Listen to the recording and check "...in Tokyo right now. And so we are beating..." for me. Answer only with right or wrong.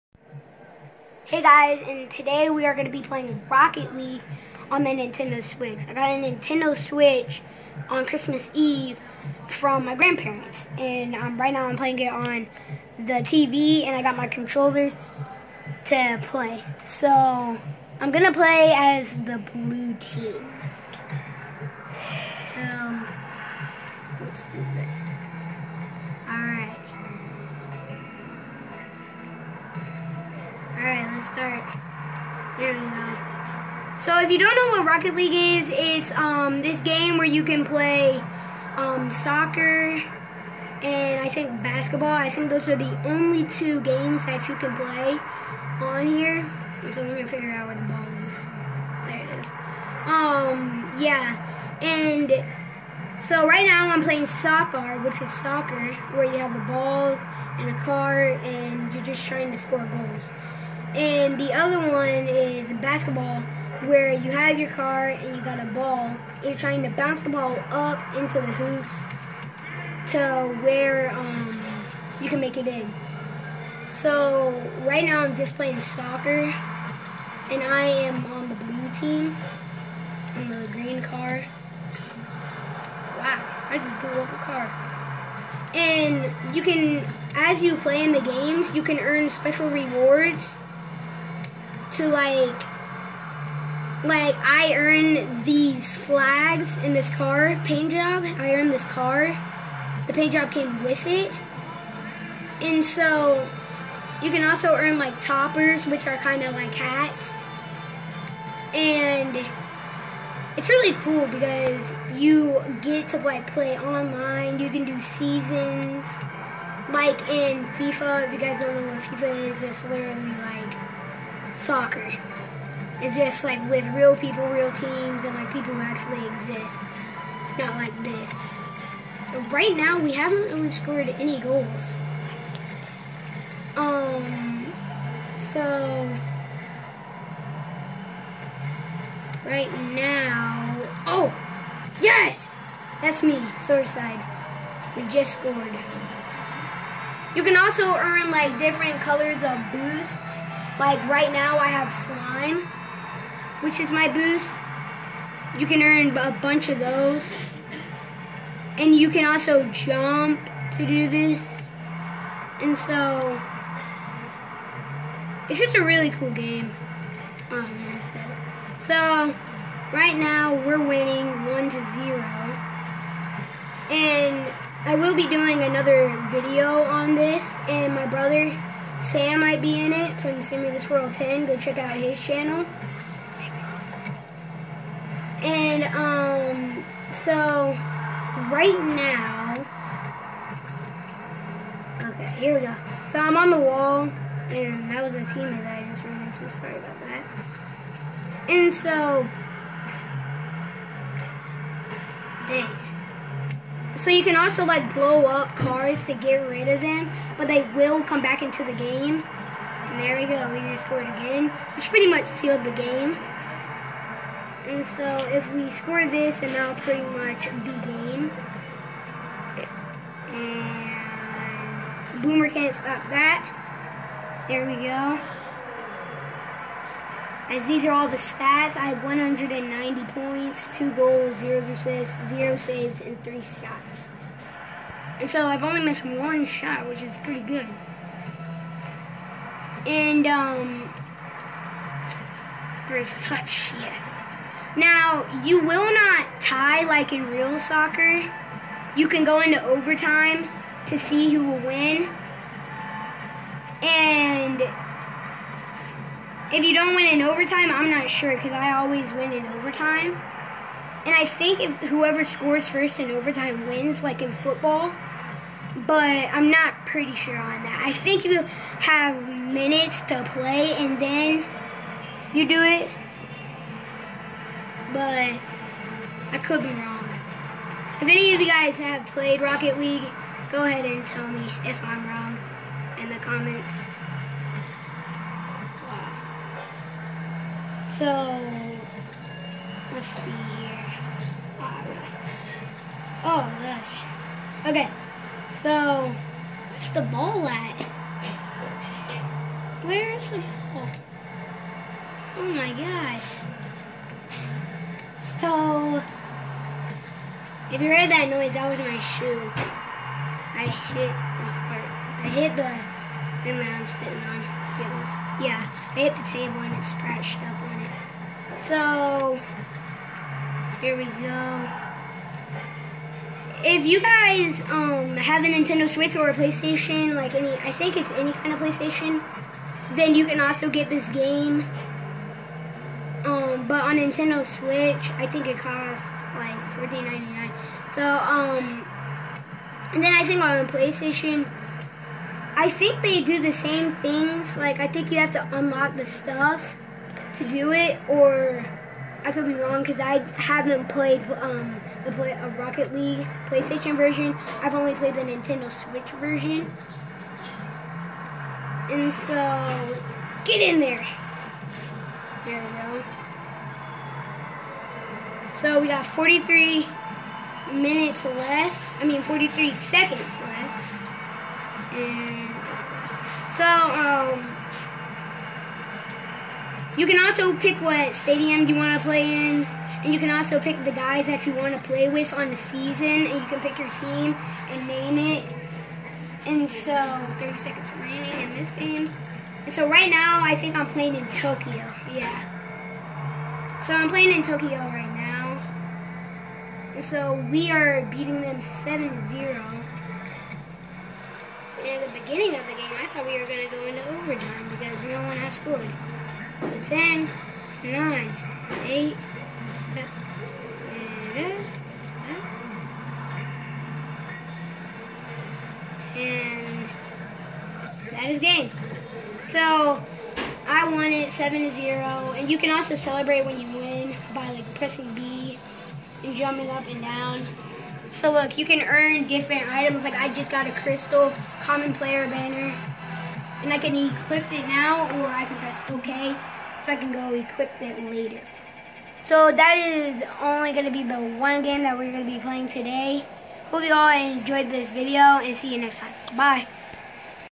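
right.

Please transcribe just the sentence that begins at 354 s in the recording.
I've only played the Nintendo Switch version, and so let's get in there.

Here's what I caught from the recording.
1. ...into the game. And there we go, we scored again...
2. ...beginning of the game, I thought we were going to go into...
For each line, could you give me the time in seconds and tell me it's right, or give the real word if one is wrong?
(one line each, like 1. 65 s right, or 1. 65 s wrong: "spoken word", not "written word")
1. 208 s right
2. 402 s right.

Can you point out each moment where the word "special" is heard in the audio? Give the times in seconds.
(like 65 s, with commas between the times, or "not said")
89 s.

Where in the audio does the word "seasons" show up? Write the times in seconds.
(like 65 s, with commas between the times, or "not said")
115 s, 382 s.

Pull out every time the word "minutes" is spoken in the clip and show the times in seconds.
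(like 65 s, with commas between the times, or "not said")
269 s, 367 s.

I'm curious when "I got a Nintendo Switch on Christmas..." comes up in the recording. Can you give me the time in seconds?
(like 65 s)
5 s.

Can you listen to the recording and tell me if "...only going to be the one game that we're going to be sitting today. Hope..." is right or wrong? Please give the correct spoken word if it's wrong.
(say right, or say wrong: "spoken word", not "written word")
wrong: "playing", not "sitting".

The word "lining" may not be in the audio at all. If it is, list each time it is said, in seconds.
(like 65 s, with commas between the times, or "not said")
not said.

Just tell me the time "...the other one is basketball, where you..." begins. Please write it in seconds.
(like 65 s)
61 s.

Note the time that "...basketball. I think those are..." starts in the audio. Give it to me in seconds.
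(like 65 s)
41 s.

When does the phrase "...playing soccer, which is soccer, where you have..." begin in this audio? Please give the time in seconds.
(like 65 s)
54 s.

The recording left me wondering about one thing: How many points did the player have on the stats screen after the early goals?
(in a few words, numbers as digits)
190.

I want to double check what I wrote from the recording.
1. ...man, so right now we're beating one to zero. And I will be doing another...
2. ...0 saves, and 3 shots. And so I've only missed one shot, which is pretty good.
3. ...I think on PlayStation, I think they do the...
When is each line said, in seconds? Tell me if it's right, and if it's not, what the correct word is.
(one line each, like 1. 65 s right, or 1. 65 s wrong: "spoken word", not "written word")
1. 167 s wrong: "winning", not "beating"
2. 232 s right
3. 340 s right.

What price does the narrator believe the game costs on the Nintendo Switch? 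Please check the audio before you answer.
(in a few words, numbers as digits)
$14.99.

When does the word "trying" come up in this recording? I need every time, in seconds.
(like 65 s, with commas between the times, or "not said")
59 s, 66 s.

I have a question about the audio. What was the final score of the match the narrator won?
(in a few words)
7-0.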